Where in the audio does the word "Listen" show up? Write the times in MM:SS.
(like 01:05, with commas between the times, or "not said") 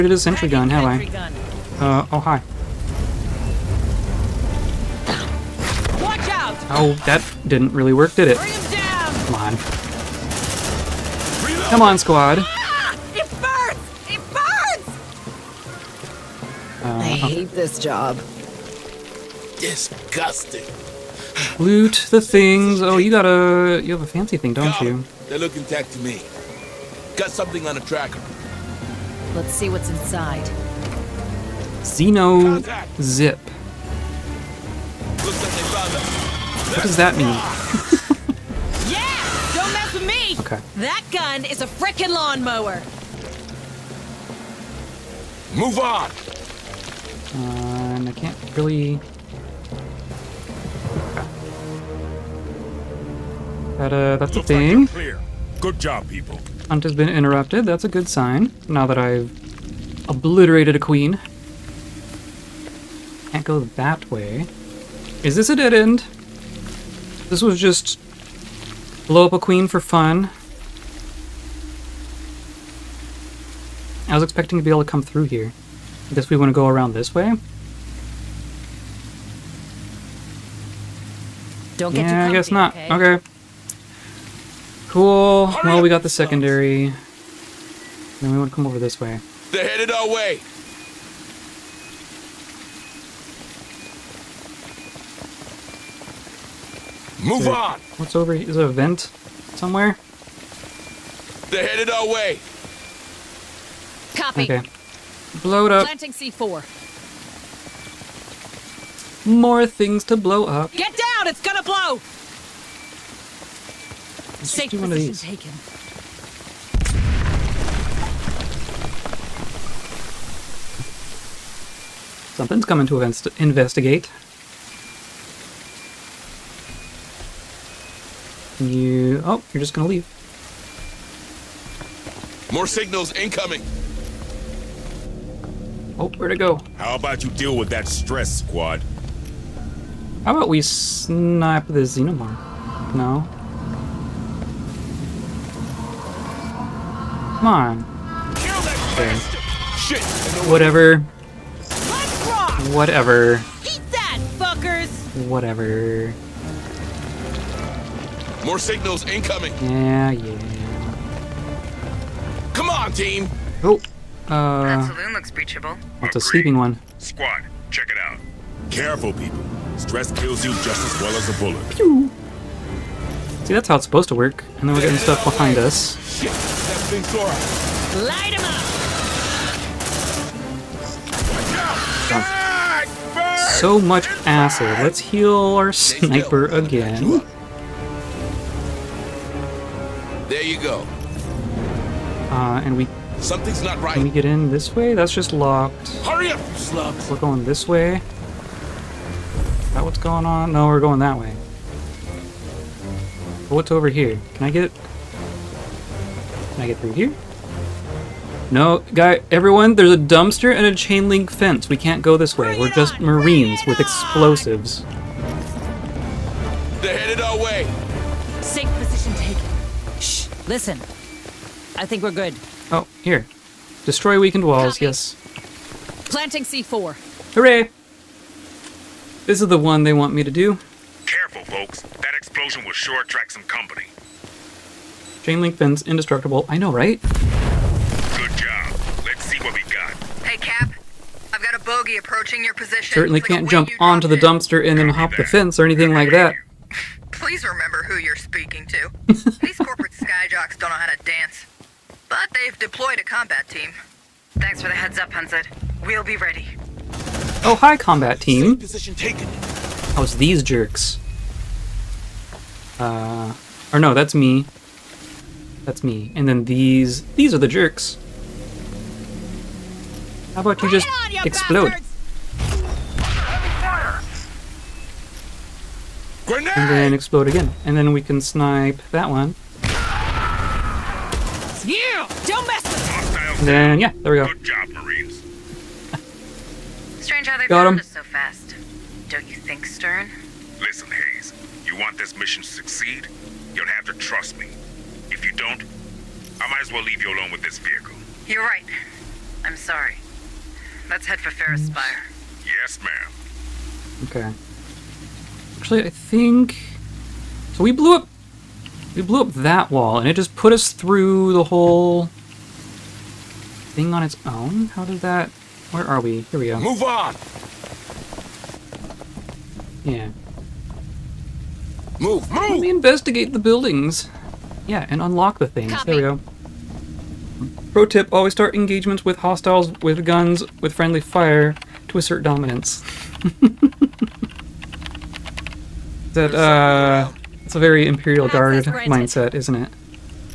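03:40, 04:50.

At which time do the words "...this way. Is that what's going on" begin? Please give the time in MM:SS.
03:17.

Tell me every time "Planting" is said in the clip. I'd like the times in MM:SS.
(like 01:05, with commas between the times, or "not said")
01:45, 03:46.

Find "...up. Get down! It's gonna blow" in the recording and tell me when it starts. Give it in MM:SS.
01:50.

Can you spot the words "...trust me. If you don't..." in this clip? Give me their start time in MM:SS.
04:53.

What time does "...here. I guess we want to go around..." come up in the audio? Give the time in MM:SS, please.
01:15.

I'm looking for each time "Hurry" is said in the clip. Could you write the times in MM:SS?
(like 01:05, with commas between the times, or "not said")
03:16.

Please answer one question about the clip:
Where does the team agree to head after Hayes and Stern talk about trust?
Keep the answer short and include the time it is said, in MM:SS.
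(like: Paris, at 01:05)
Pharos Spire, at 05:01.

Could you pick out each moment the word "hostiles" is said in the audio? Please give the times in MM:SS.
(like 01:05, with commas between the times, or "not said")
05:29.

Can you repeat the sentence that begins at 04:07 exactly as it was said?
Please remember who you're speaking to.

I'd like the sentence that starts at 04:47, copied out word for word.
Strange how they Got found him.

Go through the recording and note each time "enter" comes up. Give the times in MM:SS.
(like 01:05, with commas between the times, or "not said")
not said.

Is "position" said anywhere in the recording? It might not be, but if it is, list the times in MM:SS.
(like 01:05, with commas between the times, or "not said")
04:02, 04:18.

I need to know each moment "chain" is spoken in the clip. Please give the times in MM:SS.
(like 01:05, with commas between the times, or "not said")
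03:30, 03:55.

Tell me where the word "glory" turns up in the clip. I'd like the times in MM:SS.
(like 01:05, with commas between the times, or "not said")
not said.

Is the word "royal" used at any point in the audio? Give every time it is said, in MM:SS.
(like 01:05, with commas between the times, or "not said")
not said.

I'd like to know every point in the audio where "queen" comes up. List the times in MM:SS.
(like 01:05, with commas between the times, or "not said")
01:00, 01:09.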